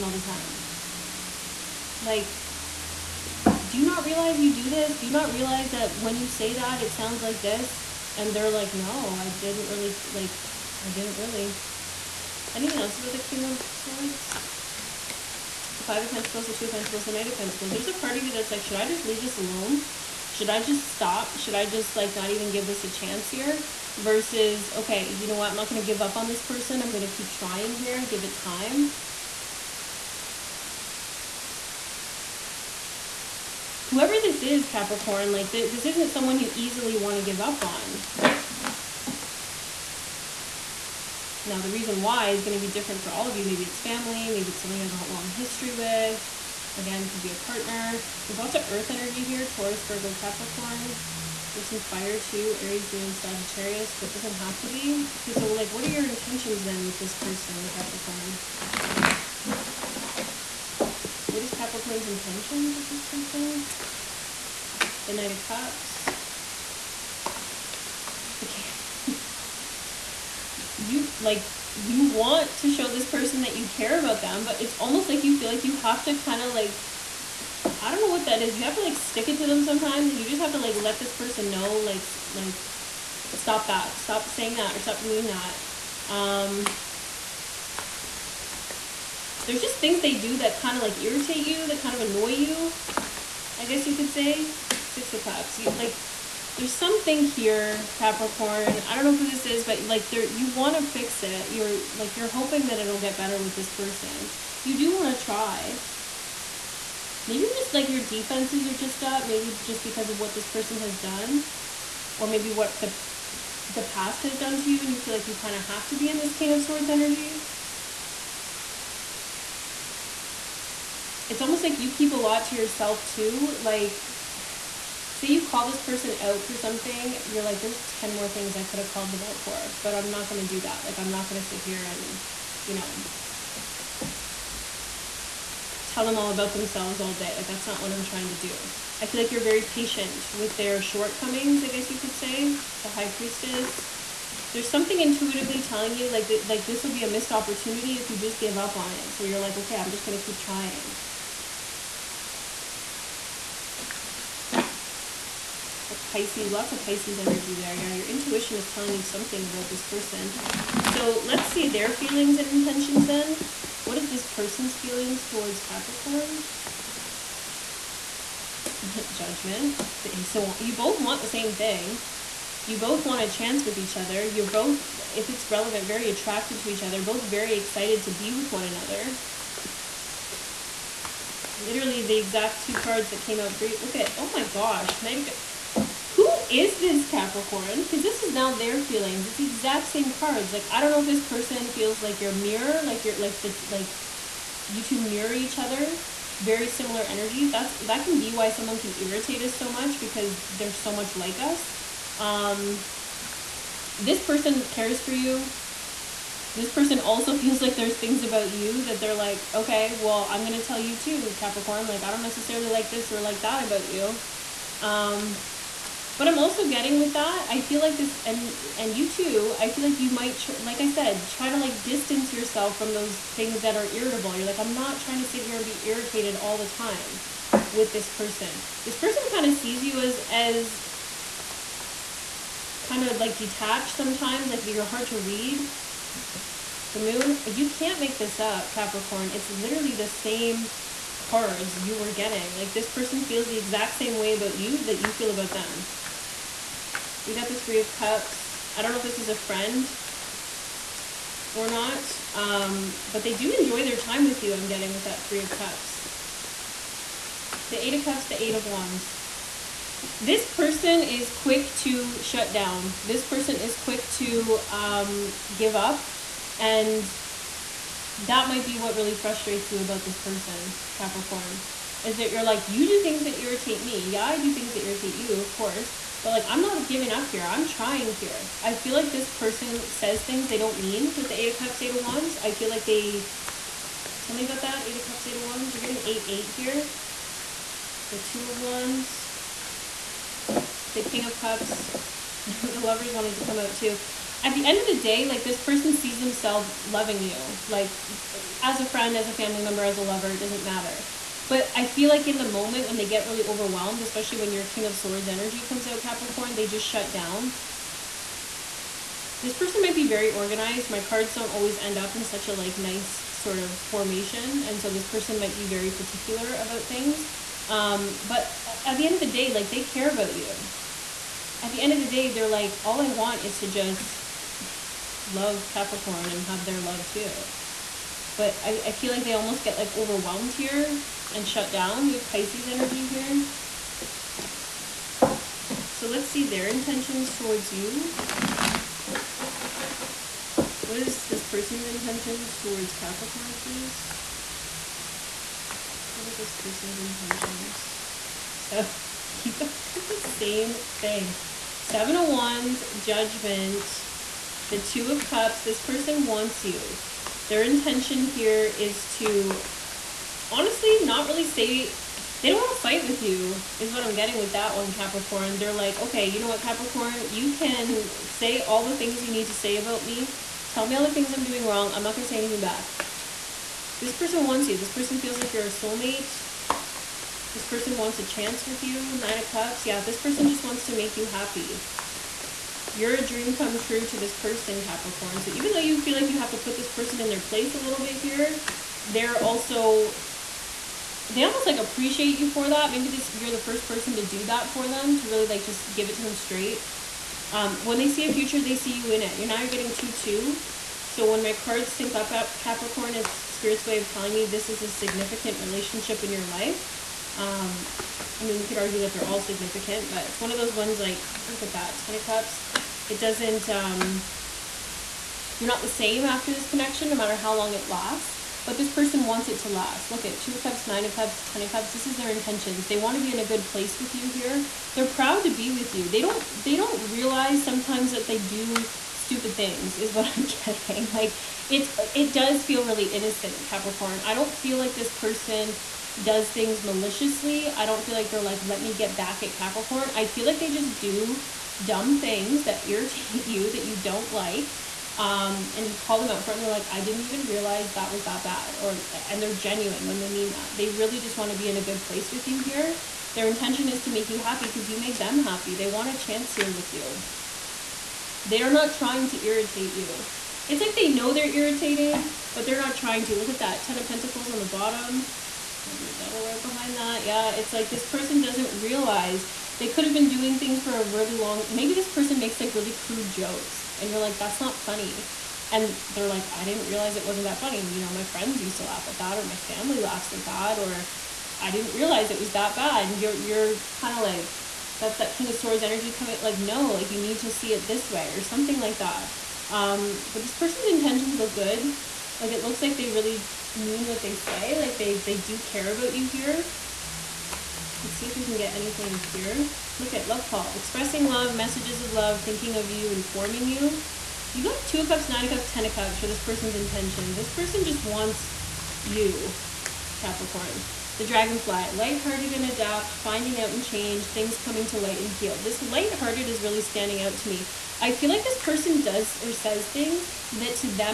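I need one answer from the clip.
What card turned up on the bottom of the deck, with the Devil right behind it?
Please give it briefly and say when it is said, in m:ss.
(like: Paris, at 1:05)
Ten of Pentacles, at 7:43.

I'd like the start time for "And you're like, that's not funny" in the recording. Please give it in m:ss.
7:53.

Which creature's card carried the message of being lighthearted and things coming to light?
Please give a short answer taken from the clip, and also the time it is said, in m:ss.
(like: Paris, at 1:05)
Dragonfly, at 8:31.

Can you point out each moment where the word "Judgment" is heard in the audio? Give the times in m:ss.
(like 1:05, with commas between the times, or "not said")
2:49, 5:52.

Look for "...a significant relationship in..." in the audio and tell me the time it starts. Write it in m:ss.
6:44.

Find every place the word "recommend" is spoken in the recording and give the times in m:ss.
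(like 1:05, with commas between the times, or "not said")
not said.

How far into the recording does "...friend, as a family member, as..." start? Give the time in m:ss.
4:58.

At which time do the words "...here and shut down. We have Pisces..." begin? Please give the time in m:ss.
5:30.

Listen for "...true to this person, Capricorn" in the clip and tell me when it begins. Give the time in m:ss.
6:23.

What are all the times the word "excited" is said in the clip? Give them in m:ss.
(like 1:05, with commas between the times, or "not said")
2:57.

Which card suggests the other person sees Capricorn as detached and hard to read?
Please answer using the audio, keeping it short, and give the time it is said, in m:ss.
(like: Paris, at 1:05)
The Moon, at 3:56.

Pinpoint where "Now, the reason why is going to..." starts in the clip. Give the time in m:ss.
0:41.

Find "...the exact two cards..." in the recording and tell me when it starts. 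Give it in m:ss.
3:02.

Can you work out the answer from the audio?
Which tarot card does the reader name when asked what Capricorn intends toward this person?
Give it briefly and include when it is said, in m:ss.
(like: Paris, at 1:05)
Knight of Cups, at 1:05.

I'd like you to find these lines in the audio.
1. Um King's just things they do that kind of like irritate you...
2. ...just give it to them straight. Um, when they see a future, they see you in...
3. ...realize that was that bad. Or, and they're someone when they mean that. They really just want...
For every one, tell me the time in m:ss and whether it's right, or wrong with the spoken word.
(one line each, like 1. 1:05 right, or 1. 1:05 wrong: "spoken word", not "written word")
1. 1:26 wrong: "There", not "King"
2. 6:35 right
3. 7:27 wrong: "genuine", not "someone".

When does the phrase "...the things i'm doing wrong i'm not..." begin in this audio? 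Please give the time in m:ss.
6:11.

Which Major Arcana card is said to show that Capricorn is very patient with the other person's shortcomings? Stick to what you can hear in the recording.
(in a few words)
The High Priestess.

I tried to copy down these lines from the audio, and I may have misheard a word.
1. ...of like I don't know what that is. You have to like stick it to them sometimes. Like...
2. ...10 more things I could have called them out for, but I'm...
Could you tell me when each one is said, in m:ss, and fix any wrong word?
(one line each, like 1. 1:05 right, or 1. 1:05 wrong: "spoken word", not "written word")
1. 1:16 right
2. 2:07 right.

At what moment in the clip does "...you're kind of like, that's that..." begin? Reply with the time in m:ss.
8:03.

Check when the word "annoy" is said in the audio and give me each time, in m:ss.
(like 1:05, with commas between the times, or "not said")
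1:32.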